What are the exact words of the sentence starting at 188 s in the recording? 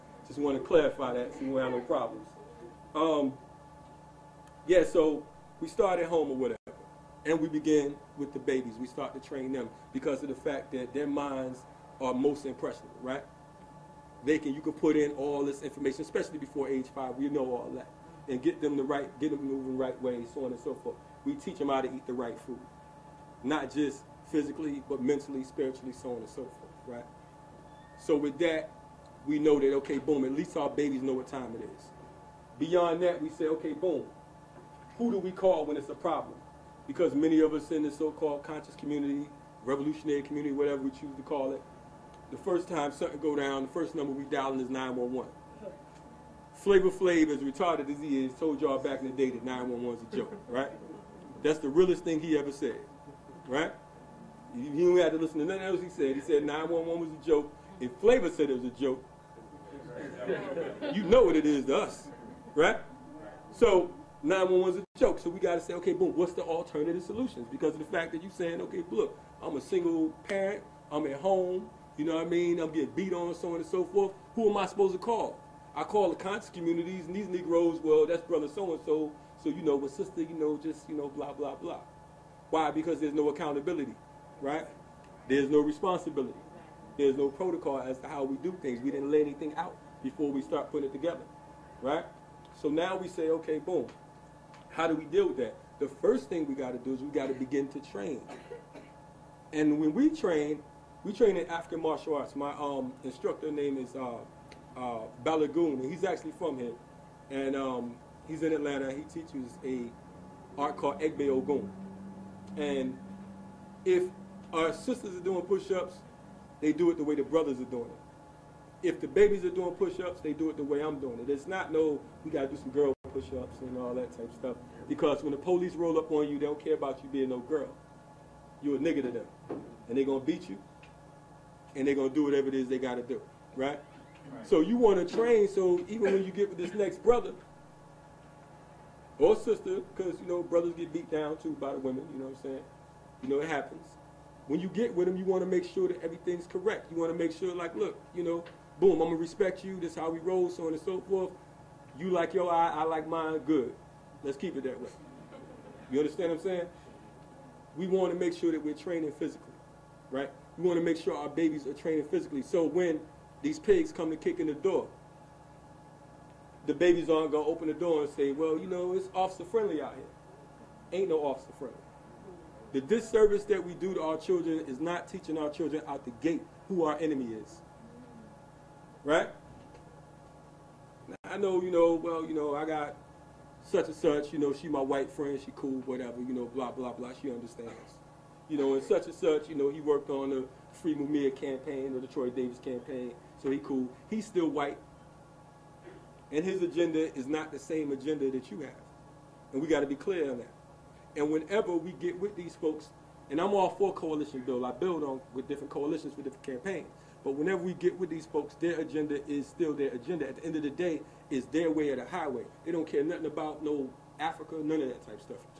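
You know, and such and such, you know, he worked on the Free Mumia campaign the Troy Davis campaign, so he cool.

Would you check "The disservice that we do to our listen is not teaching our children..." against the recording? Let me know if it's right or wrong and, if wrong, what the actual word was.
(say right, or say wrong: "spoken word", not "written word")
wrong: "children", not "listen".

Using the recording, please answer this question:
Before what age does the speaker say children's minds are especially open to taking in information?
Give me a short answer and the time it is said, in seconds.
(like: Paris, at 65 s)
5, at 16 s.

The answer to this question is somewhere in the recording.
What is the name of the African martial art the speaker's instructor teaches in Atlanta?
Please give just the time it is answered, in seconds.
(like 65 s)
111 s.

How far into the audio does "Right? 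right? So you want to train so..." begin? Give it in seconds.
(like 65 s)
133 s.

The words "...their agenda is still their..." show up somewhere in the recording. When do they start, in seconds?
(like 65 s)
208 s.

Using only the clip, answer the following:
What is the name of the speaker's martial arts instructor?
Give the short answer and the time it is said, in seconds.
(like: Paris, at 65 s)
Balagoon, at 105 s.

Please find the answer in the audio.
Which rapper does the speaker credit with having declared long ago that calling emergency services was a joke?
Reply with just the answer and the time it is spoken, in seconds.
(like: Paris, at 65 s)
Flavor Flav, at 46 s.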